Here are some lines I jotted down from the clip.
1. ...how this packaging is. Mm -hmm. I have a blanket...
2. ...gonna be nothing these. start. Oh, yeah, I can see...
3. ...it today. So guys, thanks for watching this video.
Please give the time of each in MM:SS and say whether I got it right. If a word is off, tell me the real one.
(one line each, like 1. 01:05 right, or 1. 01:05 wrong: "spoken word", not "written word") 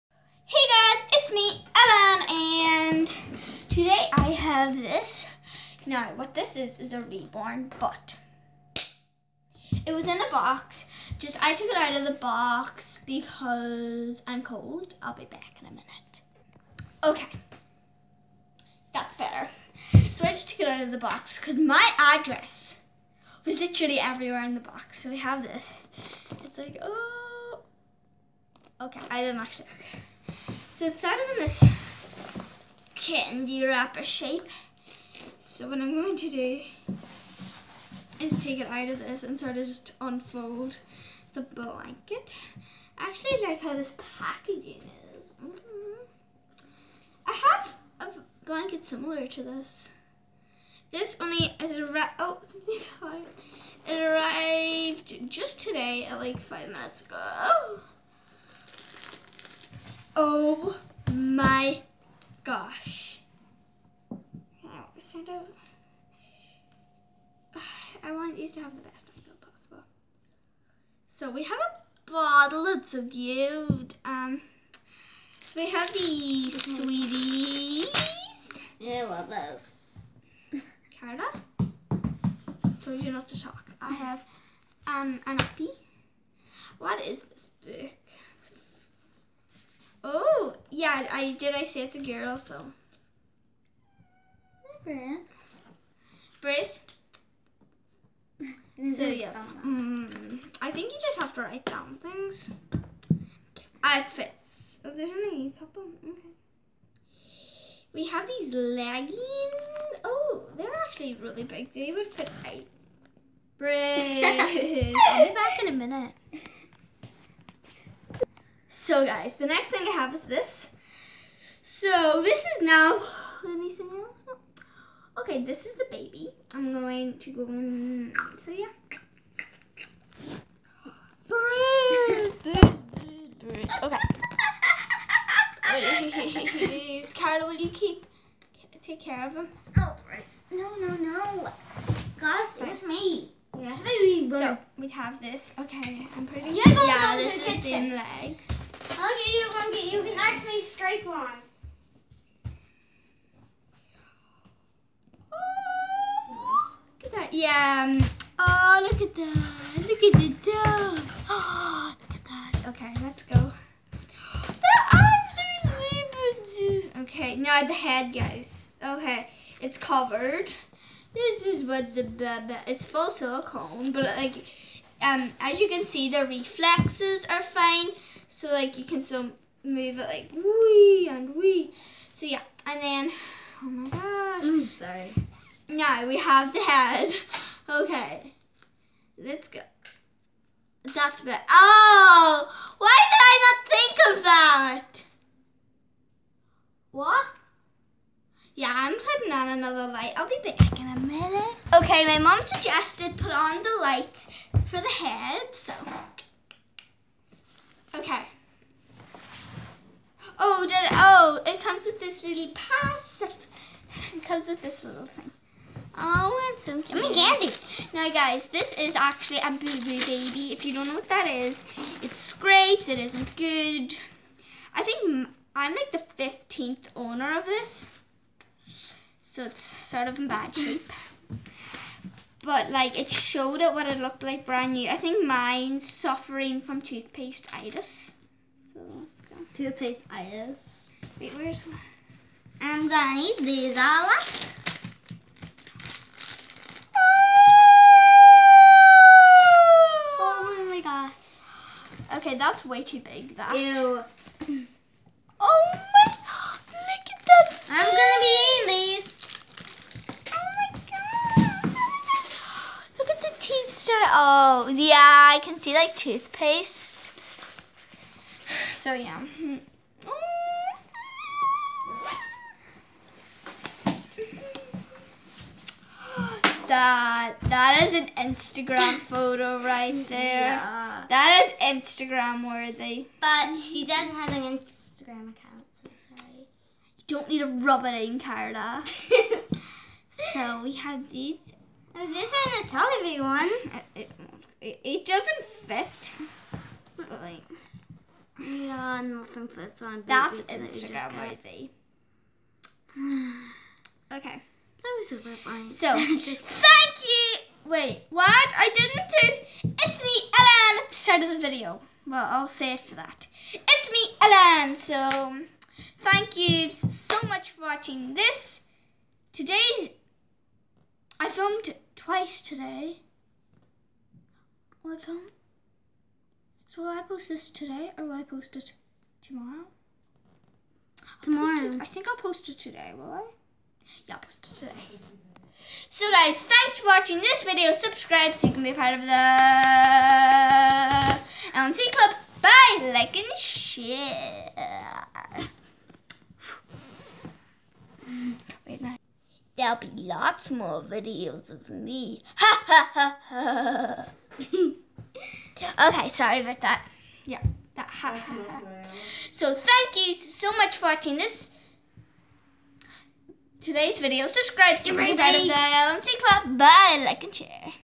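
1. 00:43 right
2. 04:17 wrong: "eating", not "nothing"
3. 05:34 right.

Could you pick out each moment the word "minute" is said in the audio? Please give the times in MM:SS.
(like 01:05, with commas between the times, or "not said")
00:15, 00:56, 01:55, 03:20.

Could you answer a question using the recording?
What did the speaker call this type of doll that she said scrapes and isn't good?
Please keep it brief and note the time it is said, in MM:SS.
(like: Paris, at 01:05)
boo-boo baby, at 03:39.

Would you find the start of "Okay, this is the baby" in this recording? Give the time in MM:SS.
02:05.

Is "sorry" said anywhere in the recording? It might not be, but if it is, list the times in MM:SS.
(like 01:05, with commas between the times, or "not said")
03:04, 04:45, 05:56.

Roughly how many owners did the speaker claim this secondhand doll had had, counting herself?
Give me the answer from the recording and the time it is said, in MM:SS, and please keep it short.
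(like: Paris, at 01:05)
15th, at 03:46.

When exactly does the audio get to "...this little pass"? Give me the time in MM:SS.
03:31.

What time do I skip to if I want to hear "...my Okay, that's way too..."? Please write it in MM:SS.
04:10.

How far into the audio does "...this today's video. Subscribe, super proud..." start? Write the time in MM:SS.
06:01.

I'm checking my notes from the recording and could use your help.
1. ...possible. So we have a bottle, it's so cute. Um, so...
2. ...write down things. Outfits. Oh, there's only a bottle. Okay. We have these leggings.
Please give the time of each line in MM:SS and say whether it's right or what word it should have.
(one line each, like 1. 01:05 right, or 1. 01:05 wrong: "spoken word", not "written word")
1. 01:09 right
2. 01:41 wrong: "couple", not "bottle".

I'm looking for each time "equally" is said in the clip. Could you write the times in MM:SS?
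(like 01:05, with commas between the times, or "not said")
not said.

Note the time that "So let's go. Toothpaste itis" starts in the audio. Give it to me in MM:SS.
03:58.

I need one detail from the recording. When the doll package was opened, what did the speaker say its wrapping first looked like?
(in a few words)
Candy wrapper.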